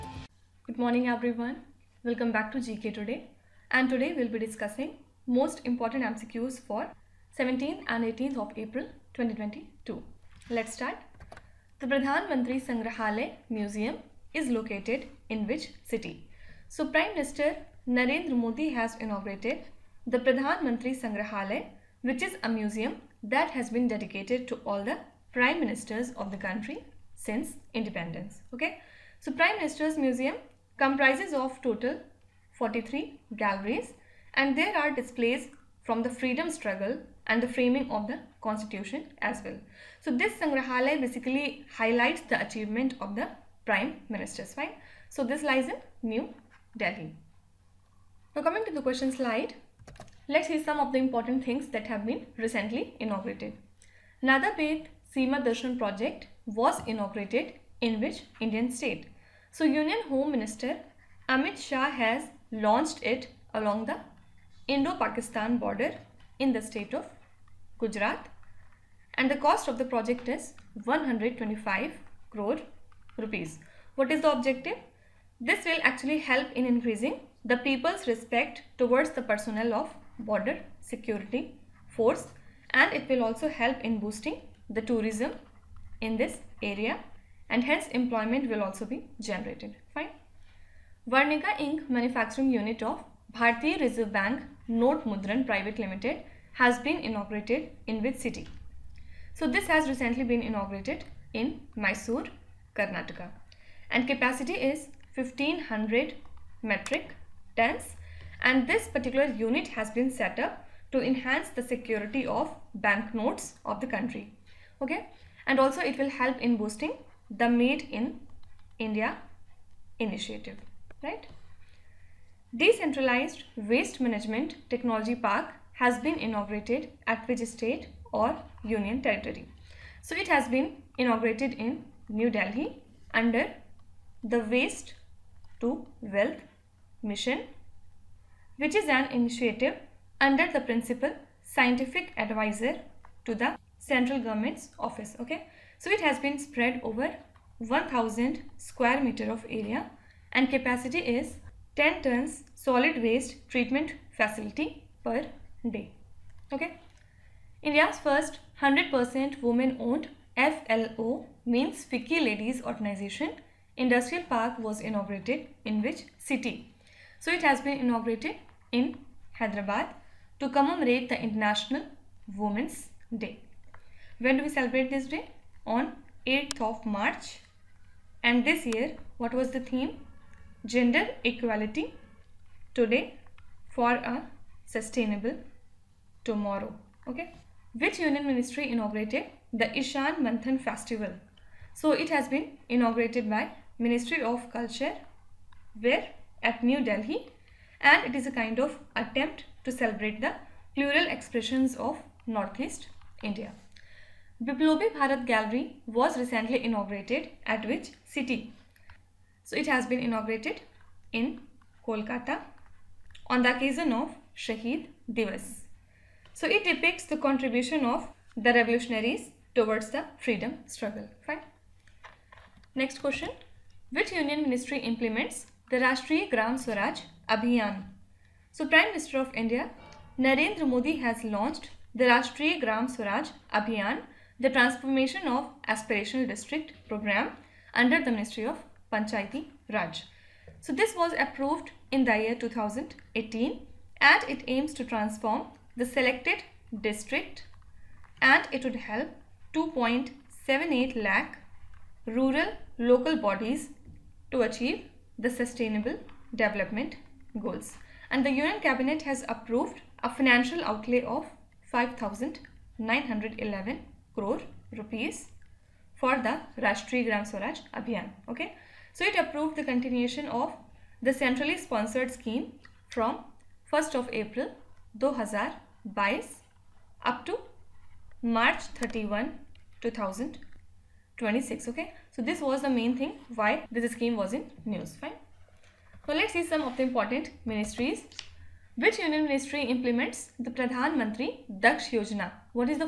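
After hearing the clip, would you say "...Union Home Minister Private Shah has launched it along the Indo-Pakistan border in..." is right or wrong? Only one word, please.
wrong.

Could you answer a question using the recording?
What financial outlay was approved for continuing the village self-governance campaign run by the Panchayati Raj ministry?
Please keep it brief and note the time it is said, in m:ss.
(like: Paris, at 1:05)
5,911 crore rupees, at 4:21.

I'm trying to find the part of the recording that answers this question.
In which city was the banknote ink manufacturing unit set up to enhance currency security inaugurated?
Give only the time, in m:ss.
1:41.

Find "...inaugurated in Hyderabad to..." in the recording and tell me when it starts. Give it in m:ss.
2:47.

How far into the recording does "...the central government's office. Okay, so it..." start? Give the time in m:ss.
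2:23.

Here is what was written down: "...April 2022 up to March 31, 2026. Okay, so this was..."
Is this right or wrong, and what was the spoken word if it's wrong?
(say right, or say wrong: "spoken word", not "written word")
right.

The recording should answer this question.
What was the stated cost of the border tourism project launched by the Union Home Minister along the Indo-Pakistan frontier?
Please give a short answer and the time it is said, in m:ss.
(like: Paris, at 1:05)
125 crore rupees, at 1:10.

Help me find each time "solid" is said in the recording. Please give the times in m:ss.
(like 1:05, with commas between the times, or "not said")
2:32.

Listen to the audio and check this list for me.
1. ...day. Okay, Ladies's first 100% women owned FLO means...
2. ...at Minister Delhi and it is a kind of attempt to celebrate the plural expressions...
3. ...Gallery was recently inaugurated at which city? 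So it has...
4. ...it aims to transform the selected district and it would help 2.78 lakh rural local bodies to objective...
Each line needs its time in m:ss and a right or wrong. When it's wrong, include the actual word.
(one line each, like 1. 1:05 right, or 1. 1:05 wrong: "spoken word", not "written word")
1. 2:35 wrong: "India", not "Ladies"
2. 3:16 wrong: "New", not "Minister"
3. 3:25 right
4. 4:04 wrong: "achieve", not "objective".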